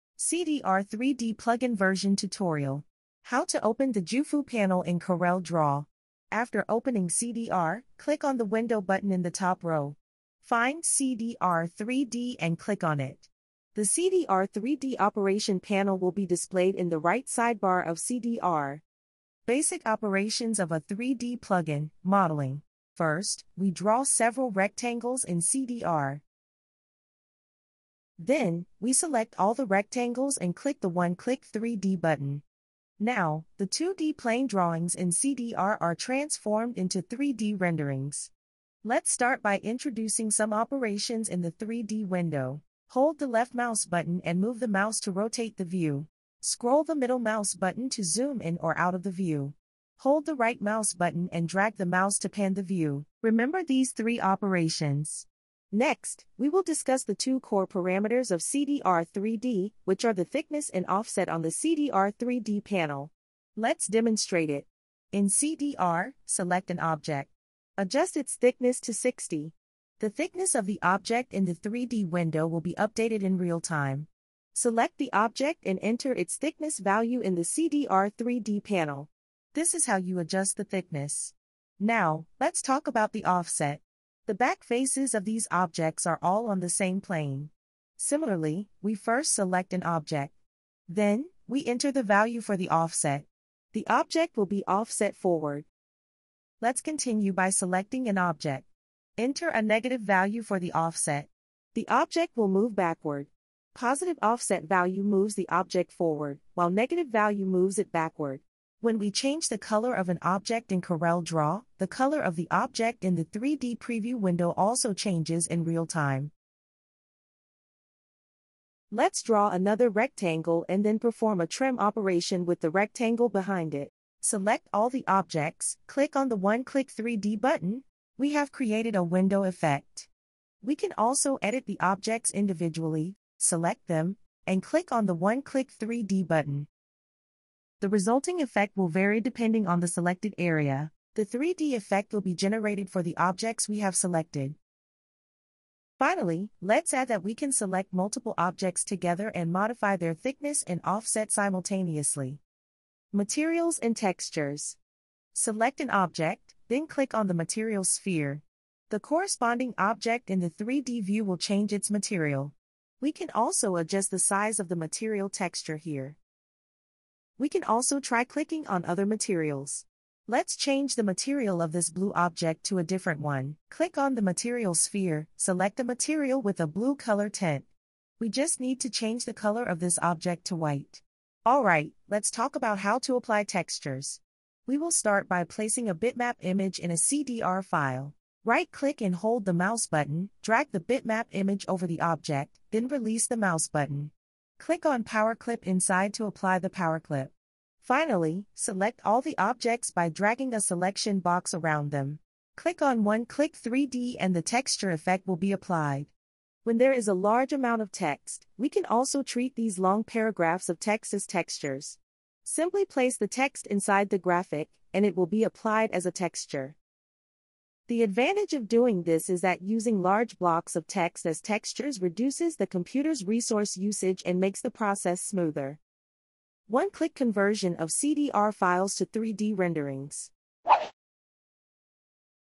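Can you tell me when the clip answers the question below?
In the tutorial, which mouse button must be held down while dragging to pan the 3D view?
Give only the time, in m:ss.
0:50.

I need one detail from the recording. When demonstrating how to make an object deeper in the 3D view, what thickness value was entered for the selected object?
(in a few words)
60.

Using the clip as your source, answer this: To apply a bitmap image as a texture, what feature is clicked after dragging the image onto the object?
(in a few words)
Power Clip inside.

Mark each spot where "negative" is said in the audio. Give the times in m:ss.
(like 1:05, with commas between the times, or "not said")
1:39, 1:46.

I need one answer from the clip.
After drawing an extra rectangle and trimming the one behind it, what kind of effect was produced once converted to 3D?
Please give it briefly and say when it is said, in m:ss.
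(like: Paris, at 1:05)
A window effect, at 2:09.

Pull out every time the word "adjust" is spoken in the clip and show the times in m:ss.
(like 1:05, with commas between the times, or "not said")
1:07, 1:20, 2:43.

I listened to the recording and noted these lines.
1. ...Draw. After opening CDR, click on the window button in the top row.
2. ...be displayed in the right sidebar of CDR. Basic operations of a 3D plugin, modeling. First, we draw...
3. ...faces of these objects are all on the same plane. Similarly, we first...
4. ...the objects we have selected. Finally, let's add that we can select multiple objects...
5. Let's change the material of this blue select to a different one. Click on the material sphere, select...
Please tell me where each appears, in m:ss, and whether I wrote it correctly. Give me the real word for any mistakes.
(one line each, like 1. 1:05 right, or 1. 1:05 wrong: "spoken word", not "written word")
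1. 0:05 right
2. 0:16 right
3. 1:24 right
4. 2:23 right
5. 2:50 wrong: "object", not "select".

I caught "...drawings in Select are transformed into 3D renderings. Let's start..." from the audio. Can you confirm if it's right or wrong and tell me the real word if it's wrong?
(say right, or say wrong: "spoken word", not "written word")
wrong: "CDR", not "Select".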